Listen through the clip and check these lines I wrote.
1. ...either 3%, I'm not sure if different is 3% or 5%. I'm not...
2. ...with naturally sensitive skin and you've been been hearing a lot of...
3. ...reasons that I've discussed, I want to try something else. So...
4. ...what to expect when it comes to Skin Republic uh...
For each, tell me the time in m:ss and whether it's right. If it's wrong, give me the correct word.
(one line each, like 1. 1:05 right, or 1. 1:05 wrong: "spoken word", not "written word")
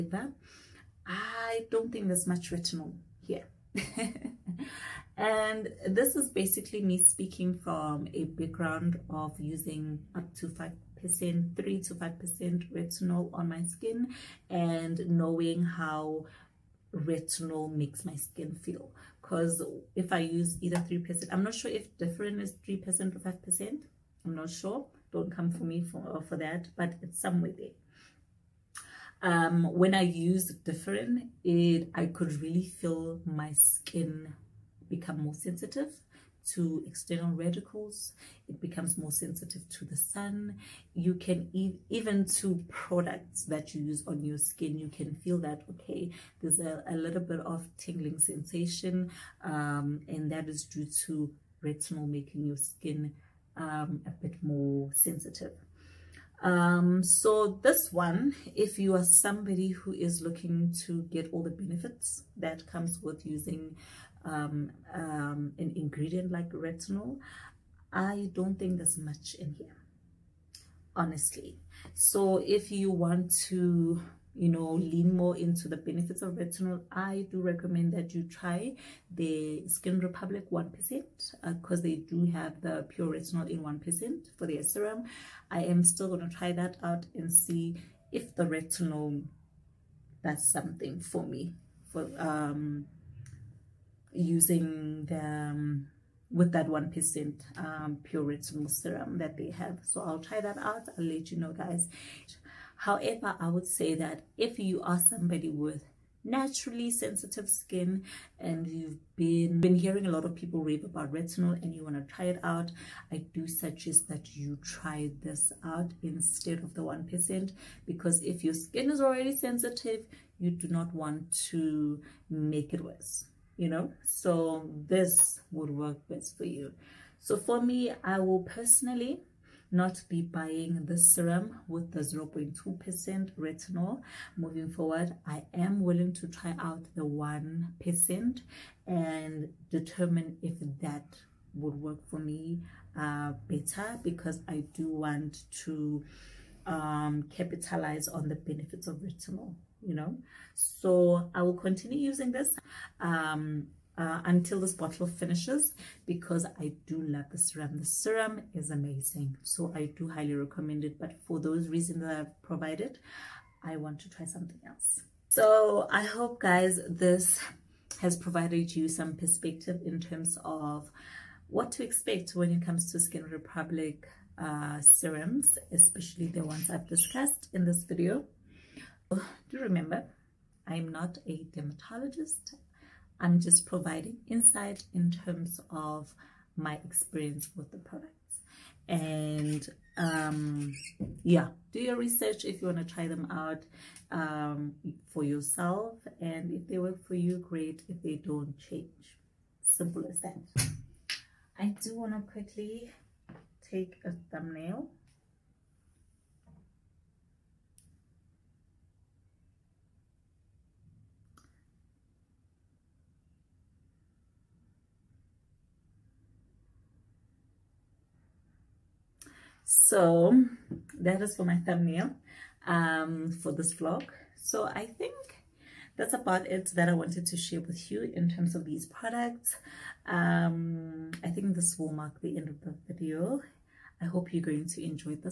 1. 0:20 right
2. 1:45 right
3. 2:41 wrong: "provided", not "discussed"
4. 2:51 right.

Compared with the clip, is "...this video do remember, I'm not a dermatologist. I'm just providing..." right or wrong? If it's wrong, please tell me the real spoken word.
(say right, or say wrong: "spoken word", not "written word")
right.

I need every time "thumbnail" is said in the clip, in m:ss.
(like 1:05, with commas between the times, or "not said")
3:24, 3:41.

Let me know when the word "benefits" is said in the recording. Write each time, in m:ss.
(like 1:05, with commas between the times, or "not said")
1:01, 1:15, 2:28.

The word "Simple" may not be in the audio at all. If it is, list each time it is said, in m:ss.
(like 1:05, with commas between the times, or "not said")
3:19.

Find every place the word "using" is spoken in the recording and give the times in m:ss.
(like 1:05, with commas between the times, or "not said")
0:09, 1:03, 1:34, 2:31.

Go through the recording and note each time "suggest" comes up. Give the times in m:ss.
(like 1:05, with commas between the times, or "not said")
1:53.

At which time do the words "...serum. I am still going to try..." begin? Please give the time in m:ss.
1:24.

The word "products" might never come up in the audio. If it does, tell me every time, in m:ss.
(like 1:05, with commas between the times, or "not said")
0:42, 3:07, 3:48.